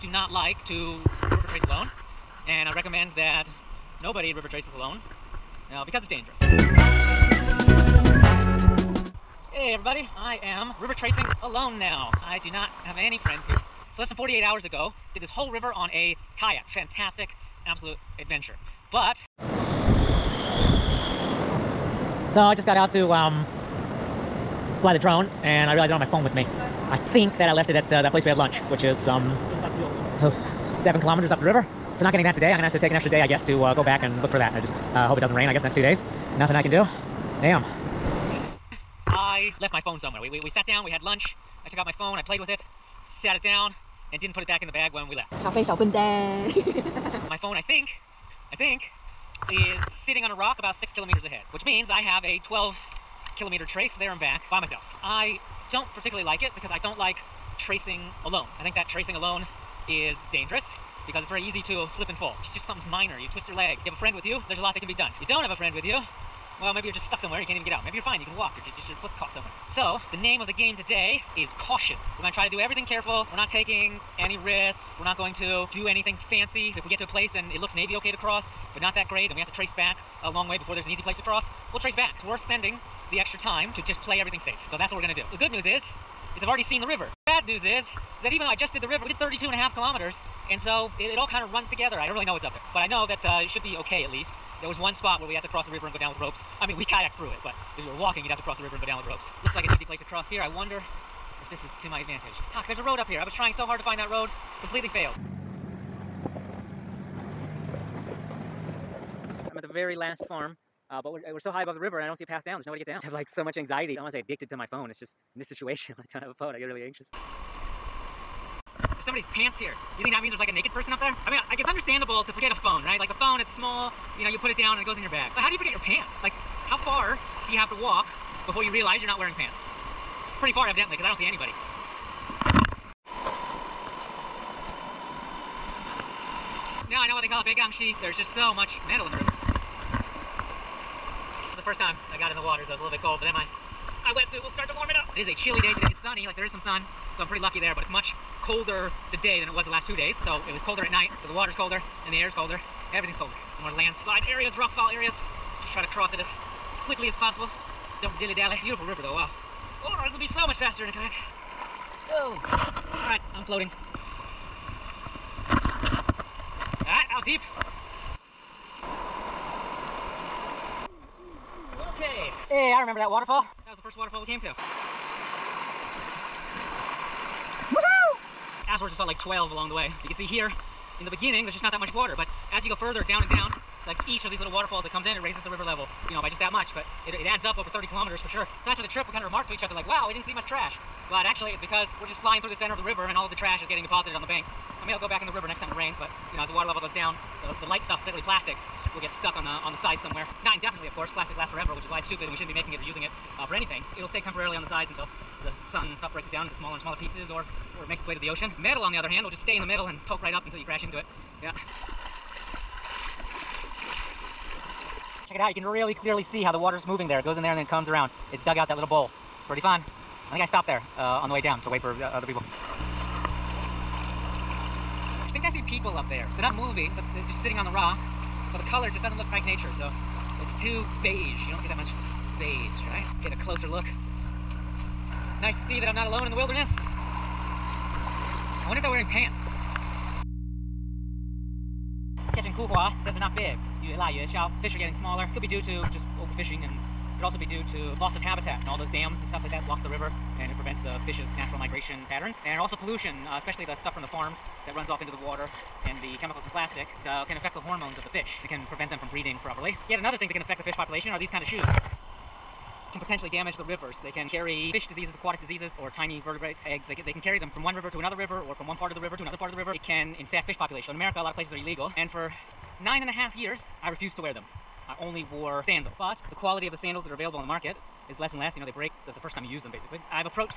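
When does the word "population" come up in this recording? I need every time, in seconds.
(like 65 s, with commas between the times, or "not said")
260 s, 270 s.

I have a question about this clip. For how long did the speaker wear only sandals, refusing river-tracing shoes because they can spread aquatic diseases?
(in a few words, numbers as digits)
9.5 years.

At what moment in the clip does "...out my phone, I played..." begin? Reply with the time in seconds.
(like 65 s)
41 s.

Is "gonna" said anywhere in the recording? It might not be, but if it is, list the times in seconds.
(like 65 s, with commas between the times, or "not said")
32 s, 72 s, 85 s.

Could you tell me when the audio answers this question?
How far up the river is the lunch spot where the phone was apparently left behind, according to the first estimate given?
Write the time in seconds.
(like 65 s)
30 s.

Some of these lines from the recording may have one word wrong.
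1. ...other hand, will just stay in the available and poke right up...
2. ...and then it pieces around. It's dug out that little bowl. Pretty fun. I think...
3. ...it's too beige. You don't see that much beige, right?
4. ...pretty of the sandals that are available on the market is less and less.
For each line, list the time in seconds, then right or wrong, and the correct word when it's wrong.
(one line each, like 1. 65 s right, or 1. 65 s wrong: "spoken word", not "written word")
1. 208 s wrong: "middle", not "available"
2. 217 s wrong: "comes", not "pieces"
3. 230 s right
4. 276 s wrong: "quality", not "pretty".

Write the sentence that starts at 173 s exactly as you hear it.
That was the first waterfall we came to.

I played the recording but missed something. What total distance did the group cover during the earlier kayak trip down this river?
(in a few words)
32.5 kilometers.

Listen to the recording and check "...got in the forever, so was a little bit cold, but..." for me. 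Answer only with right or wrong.
wrong.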